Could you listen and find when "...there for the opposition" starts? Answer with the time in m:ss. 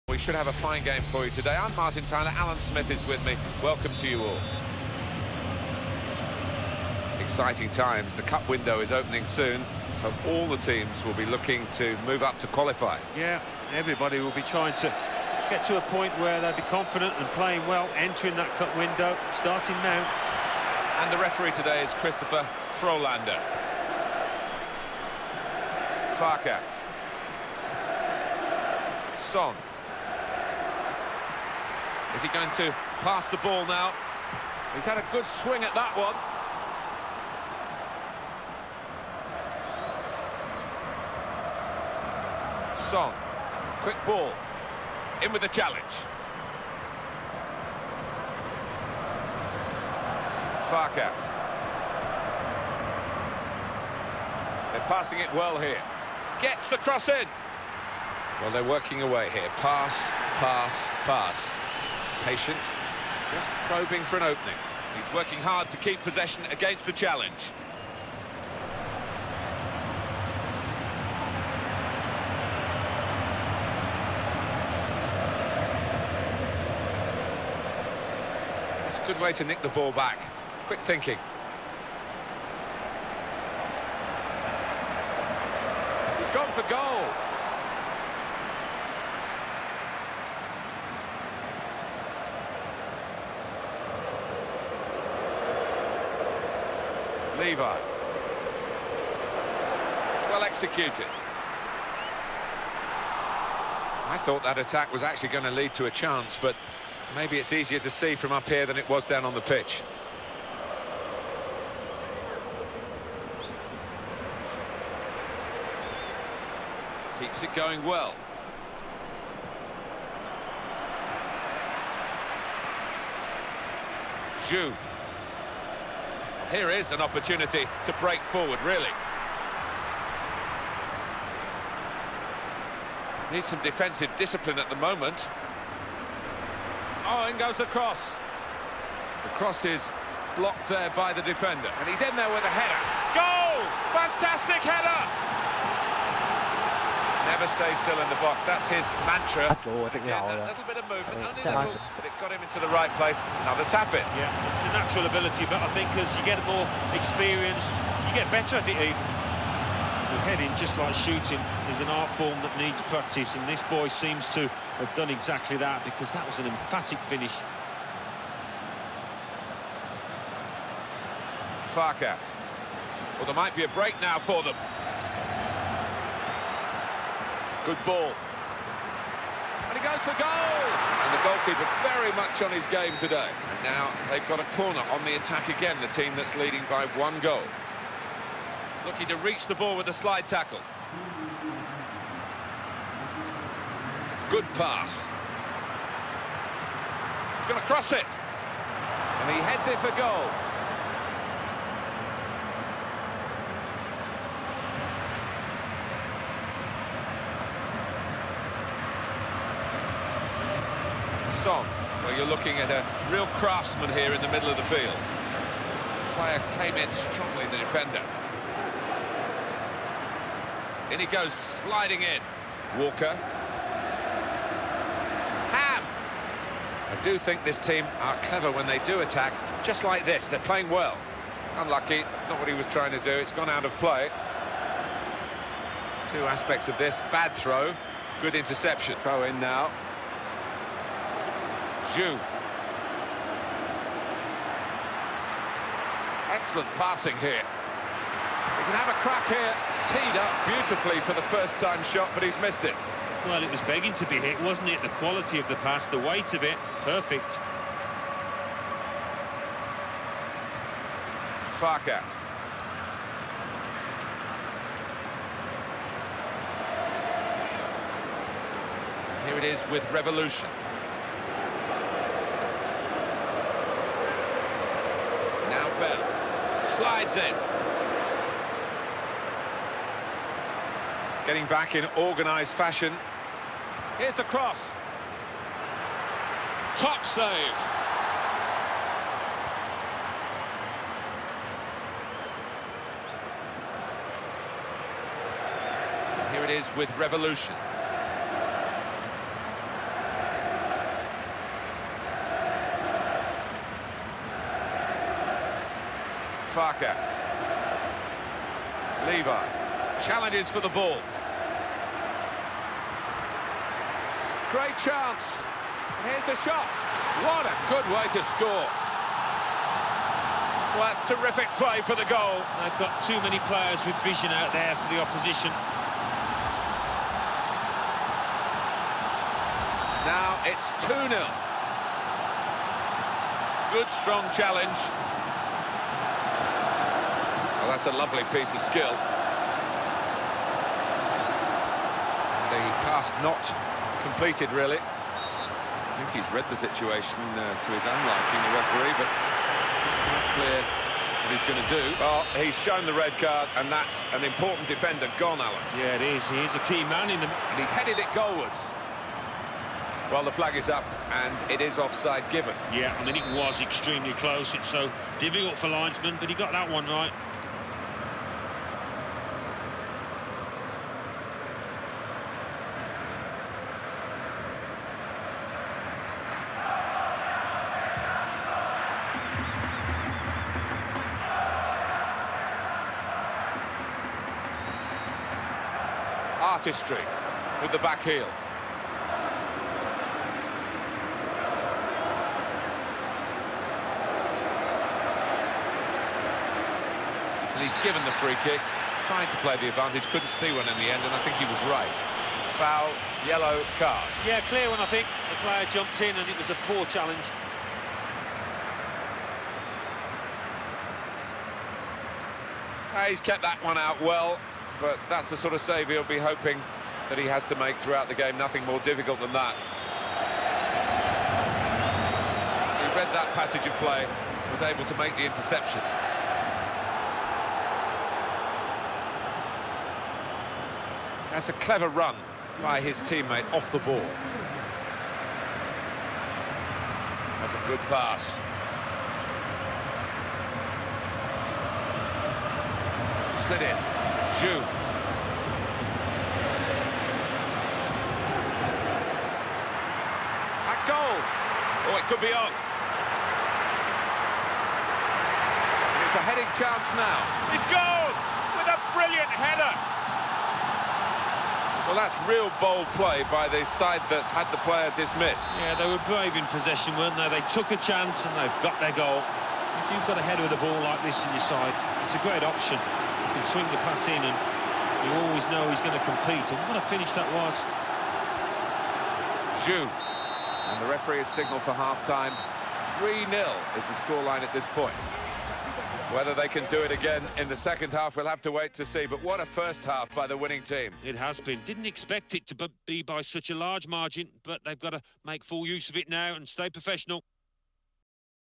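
5:24.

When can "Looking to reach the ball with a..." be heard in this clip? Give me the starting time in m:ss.
3:08.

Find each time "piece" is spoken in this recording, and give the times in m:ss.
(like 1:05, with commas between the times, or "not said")
5:38.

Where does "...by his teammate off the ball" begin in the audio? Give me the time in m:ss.
7:12.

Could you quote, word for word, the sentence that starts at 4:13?
Well, it was begging to be hit, wasn't it?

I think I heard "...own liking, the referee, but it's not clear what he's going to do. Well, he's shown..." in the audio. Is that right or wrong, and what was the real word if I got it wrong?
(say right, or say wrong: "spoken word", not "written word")
right.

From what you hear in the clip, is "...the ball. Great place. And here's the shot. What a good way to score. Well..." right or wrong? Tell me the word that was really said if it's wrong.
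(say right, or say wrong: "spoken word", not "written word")
wrong: "chance", not "place".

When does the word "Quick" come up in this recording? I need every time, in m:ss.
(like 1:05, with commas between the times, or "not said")
0:43, 1:20.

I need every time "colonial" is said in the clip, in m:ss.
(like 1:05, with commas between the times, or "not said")
not said.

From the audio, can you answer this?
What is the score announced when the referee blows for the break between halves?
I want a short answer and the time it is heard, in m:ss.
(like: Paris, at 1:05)
3-0, at 8:03.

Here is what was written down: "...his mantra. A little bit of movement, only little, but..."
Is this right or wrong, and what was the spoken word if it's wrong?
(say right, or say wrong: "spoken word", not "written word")
right.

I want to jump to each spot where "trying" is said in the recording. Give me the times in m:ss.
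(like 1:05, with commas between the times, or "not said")
0:14, 3:52, 6:39.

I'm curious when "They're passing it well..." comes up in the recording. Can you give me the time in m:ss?
0:54.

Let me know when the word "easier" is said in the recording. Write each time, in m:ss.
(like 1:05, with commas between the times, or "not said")
1:47.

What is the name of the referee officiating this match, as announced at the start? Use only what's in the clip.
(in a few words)
Christopher Frolander.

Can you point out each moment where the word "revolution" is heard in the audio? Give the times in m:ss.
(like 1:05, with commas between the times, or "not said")
4:29, 4:56.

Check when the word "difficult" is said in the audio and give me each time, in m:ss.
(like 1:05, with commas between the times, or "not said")
6:05, 6:58.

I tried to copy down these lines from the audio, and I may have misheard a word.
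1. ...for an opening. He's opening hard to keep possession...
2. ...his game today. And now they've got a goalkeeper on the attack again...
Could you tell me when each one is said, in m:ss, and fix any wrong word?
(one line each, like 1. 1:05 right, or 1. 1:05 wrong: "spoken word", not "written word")
1. 1:04 wrong: "working", not "opening"
2. 3:02 wrong: "corner", not "goalkeeper".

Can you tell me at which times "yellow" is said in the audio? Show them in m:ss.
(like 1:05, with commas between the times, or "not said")
6:43.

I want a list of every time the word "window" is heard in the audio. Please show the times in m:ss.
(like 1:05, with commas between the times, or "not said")
0:08, 0:18.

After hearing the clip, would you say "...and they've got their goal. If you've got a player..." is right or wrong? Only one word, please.
wrong.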